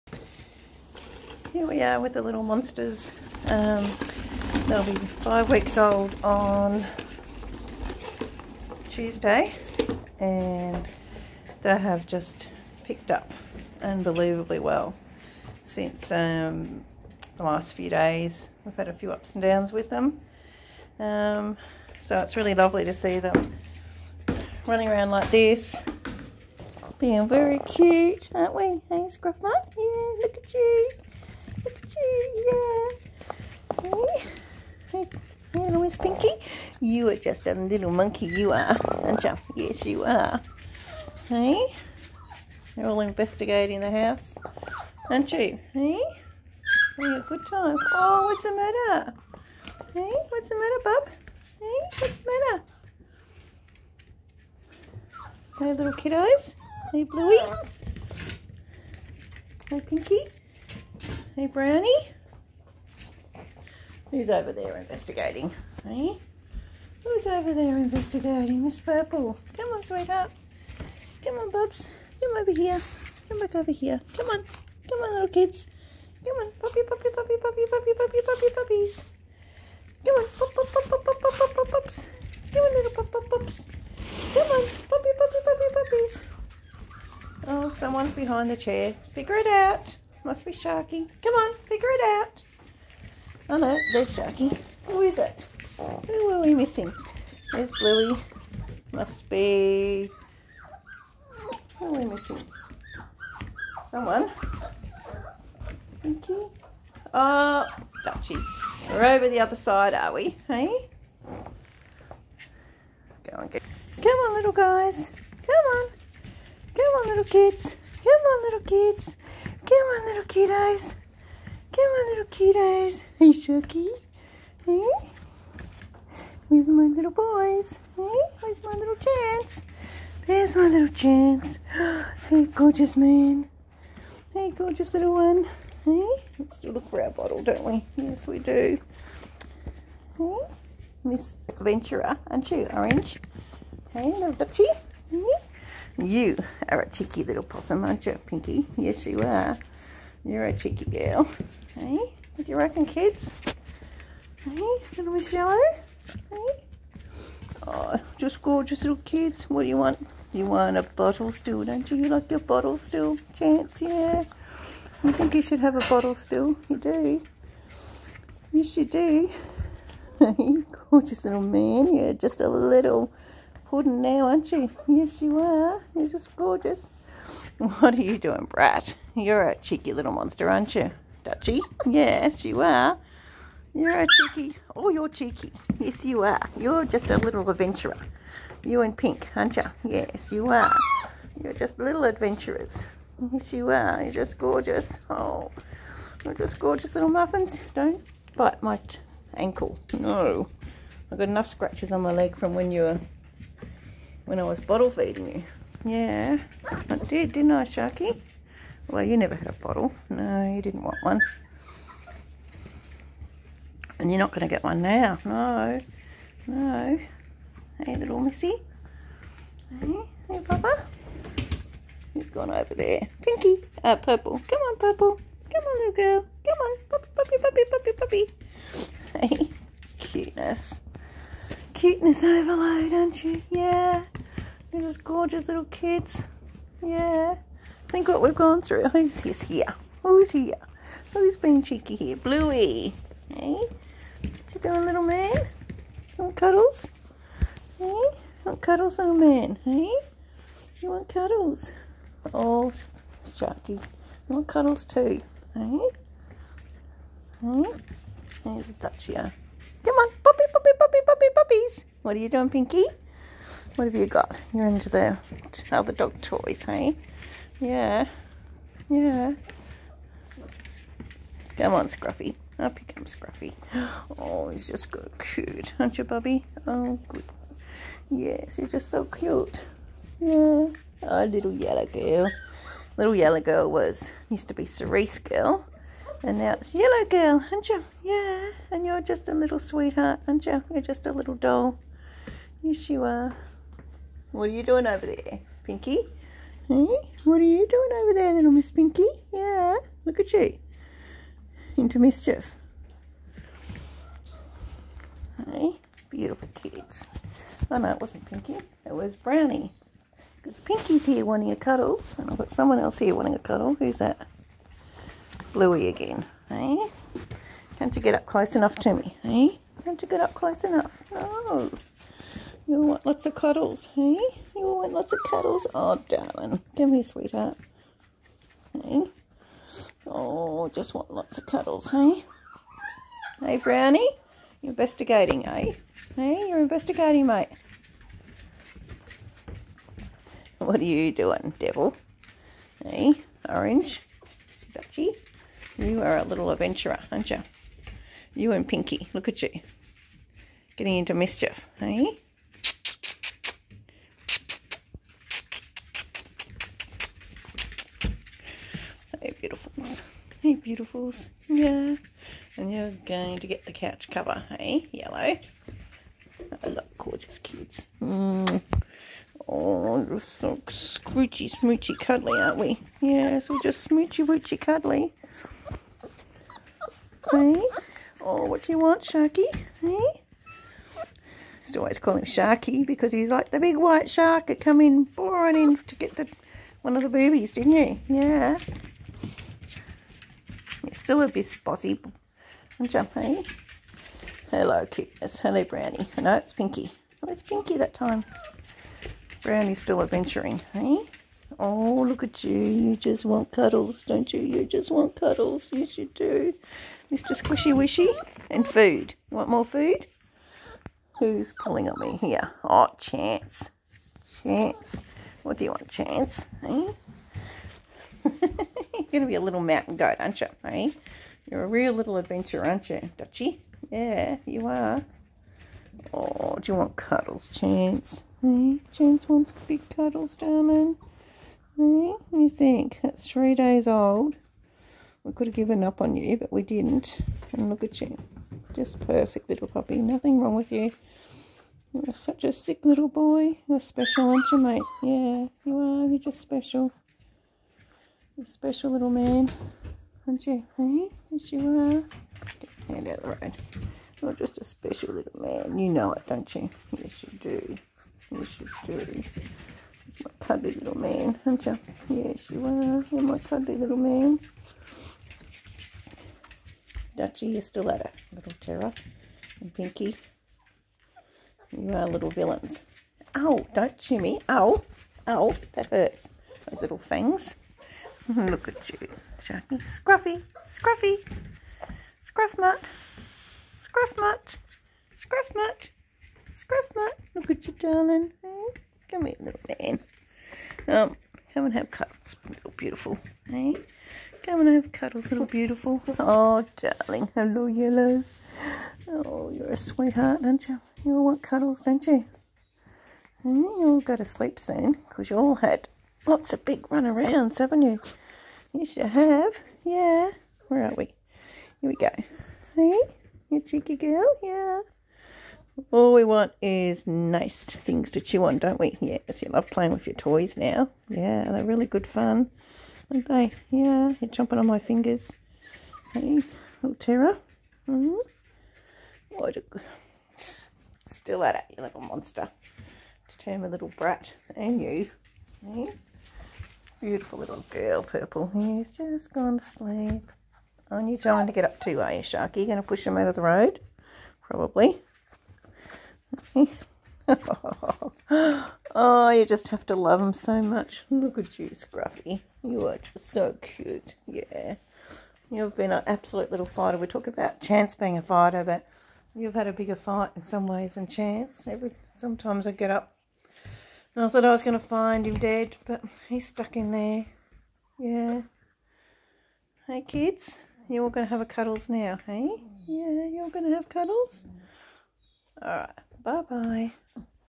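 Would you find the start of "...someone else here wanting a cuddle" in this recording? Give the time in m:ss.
5:12.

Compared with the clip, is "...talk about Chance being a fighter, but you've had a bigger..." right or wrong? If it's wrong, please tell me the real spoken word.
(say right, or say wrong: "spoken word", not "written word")
right.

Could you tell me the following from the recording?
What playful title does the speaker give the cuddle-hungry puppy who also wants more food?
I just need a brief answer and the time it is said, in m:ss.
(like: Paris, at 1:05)
Mr. Squishy Wishy, at 6:47.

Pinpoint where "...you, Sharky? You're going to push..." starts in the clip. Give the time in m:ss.
9:02.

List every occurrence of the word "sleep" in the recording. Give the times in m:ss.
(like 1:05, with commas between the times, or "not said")
8:24, 8:59.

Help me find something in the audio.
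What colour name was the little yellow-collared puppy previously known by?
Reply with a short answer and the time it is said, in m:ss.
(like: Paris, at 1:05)
Cerise, at 4:44.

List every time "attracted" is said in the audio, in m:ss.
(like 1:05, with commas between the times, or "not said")
not said.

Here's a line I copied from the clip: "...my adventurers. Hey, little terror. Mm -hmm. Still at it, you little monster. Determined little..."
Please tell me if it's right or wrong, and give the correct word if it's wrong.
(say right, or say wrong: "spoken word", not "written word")
wrong: "fingers", not "adventurers".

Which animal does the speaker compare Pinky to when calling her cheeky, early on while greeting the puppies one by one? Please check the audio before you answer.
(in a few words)
possum.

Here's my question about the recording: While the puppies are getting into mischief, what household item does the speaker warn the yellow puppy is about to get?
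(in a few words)
couch cover.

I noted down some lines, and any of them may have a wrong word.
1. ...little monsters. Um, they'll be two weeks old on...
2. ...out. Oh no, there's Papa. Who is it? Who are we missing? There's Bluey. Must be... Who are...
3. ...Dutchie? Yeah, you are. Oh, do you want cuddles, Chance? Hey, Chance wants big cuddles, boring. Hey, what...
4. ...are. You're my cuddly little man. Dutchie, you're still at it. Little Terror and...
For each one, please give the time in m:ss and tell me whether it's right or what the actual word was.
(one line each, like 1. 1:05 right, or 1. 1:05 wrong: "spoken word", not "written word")
1. 0:02 wrong: "five", not "two"
2. 1:32 wrong: "Sharky", not "Papa"
3. 7:03 wrong: "darling", not "boring"
4. 7:42 right.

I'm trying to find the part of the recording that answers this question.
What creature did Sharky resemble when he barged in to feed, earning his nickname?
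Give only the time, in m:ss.
6:23.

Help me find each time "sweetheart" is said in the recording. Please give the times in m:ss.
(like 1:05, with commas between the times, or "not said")
1:09, 4:49, 5:27, 8:19.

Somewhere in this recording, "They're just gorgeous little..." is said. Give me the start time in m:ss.
3:54.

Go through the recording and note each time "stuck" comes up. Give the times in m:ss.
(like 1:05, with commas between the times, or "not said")
9:26.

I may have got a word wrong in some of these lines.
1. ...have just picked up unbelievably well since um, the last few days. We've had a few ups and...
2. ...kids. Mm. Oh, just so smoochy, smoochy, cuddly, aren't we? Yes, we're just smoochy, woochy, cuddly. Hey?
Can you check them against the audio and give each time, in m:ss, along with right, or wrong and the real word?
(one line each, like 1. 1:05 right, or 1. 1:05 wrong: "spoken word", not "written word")
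1. 0:11 right
2. 6:07 right.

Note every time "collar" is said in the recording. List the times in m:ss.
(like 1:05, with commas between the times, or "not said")
not said.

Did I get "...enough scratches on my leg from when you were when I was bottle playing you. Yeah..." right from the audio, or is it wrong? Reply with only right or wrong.
wrong.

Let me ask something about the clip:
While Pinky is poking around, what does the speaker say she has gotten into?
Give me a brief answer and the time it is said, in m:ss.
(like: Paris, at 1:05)
dog toys, at 4:25.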